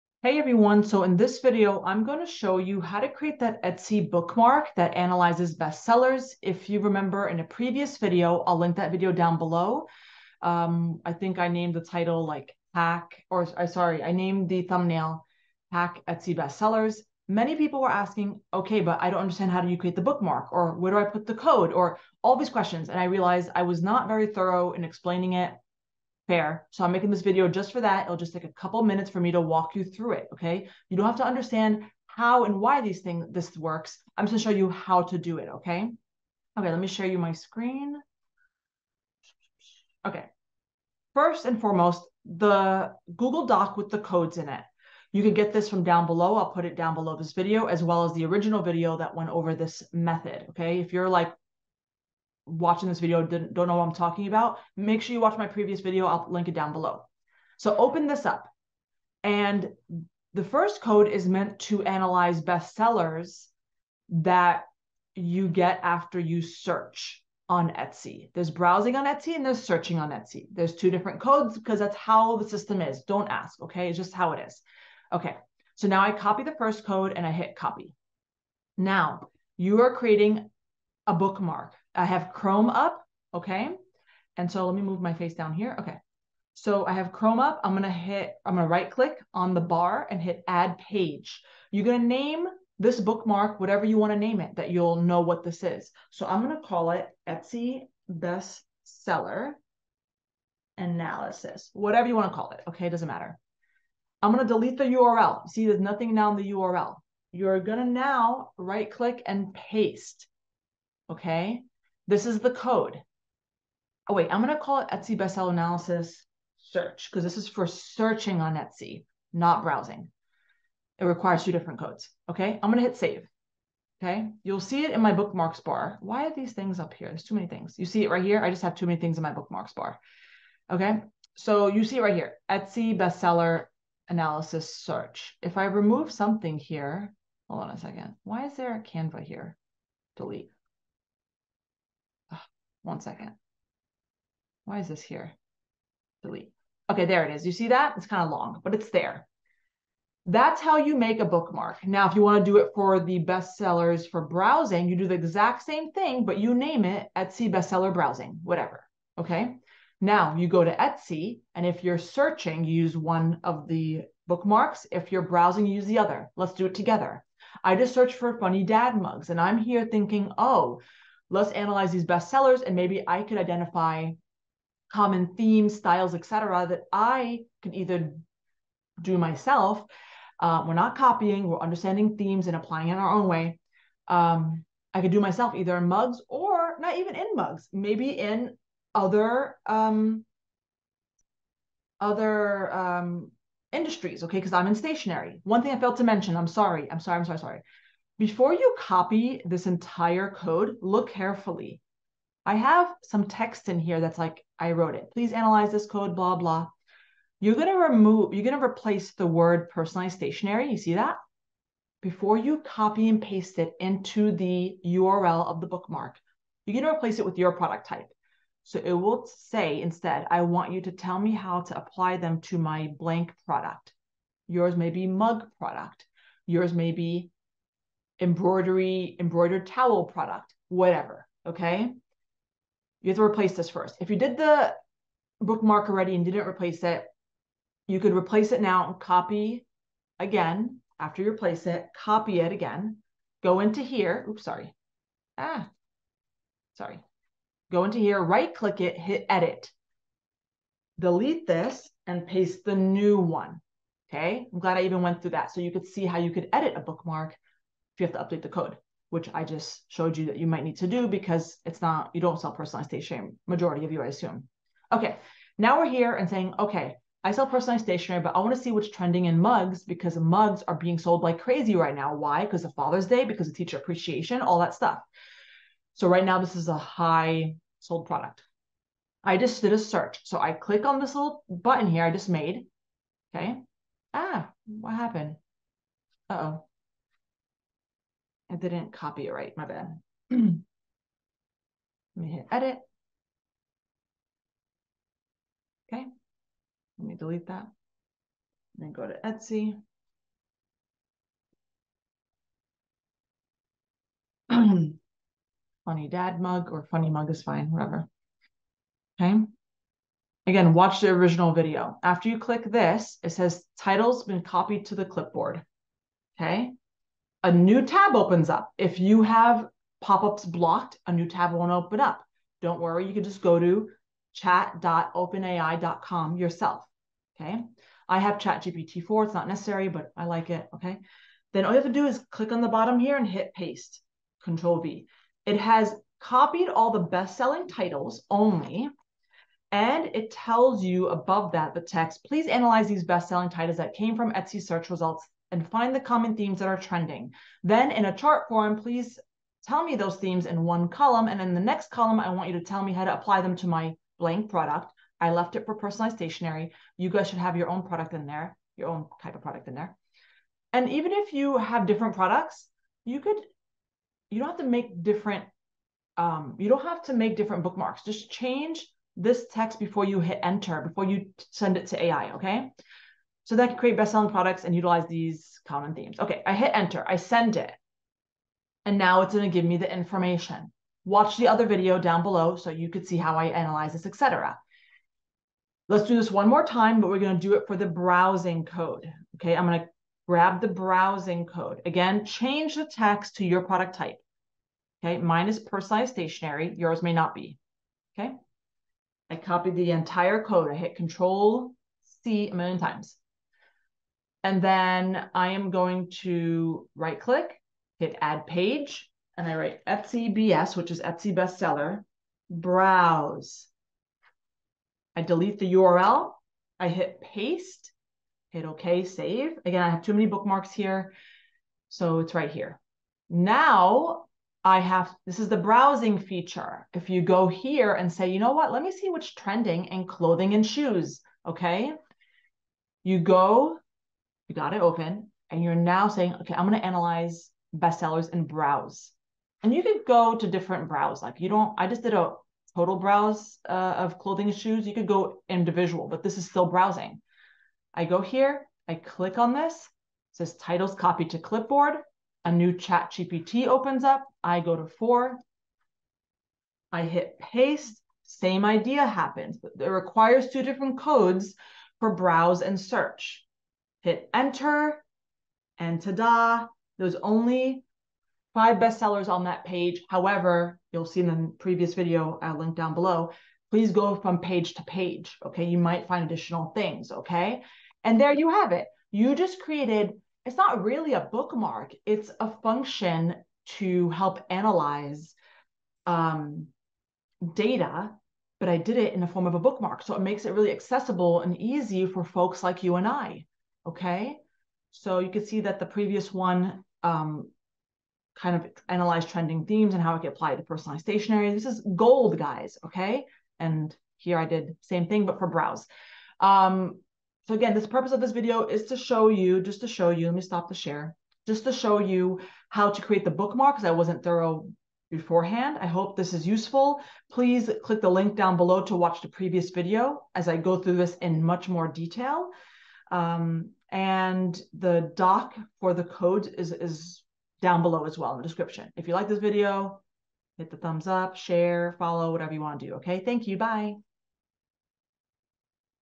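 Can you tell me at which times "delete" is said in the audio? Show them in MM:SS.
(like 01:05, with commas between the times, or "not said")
01:44, 02:20, 02:26, 04:10, 04:57, 06:55.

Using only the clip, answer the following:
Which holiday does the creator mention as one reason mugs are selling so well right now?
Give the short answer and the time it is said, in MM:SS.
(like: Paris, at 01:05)
Father's Day, at 04:32.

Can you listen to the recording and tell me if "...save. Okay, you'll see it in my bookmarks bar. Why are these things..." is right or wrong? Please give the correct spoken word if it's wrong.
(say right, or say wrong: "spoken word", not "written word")
right.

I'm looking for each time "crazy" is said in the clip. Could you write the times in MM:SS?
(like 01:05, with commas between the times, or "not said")
04:31.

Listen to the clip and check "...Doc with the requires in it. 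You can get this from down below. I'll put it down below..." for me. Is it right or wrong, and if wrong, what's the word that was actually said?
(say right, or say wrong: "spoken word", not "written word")
wrong: "codes", not "requires".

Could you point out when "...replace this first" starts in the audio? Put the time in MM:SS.
03:53.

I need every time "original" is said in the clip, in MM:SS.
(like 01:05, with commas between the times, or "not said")
00:48, 05:11.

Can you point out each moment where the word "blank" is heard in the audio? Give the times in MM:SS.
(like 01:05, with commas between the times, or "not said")
03:42, 05:54.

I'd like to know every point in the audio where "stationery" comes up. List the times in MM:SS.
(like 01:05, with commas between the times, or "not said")
03:14, 03:30, 04:22, 04:27, 05:56, 06:36, 08:21.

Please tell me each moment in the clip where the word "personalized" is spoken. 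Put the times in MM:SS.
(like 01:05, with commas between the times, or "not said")
03:29, 04:22, 04:27, 05:55, 06:35, 08:20.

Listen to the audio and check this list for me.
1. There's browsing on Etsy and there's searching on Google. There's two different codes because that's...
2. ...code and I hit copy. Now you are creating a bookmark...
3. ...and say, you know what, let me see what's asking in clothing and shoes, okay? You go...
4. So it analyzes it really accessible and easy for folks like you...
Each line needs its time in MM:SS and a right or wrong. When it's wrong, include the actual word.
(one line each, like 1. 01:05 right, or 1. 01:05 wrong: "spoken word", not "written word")
1. 01:08 wrong: "Etsy", not "Google"
2. 01:16 right
3. 07:07 wrong: "trending", not "asking"
4. 08:10 wrong: "makes", not "analyzes".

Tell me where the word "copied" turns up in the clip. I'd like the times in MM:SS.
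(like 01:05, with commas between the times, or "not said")
05:14, 05:36, 06:39, 07:30.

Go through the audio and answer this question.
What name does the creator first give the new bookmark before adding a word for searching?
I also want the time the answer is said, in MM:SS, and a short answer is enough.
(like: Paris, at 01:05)
Etsy best seller analysis, at 01:37.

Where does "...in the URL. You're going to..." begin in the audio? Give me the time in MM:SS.
01:46.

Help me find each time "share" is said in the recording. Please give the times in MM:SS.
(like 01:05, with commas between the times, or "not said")
00:36, 08:30, 08:51.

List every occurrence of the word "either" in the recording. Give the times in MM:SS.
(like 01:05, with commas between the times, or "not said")
02:57, 03:05.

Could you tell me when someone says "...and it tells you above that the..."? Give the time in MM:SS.
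05:39.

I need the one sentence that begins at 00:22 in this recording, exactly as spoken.
And I realized I was not very thorough in explaining it.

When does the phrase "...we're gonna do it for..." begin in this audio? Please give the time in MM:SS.
06:27.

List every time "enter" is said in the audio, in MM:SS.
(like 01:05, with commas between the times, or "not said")
06:10, 06:16, 07:44.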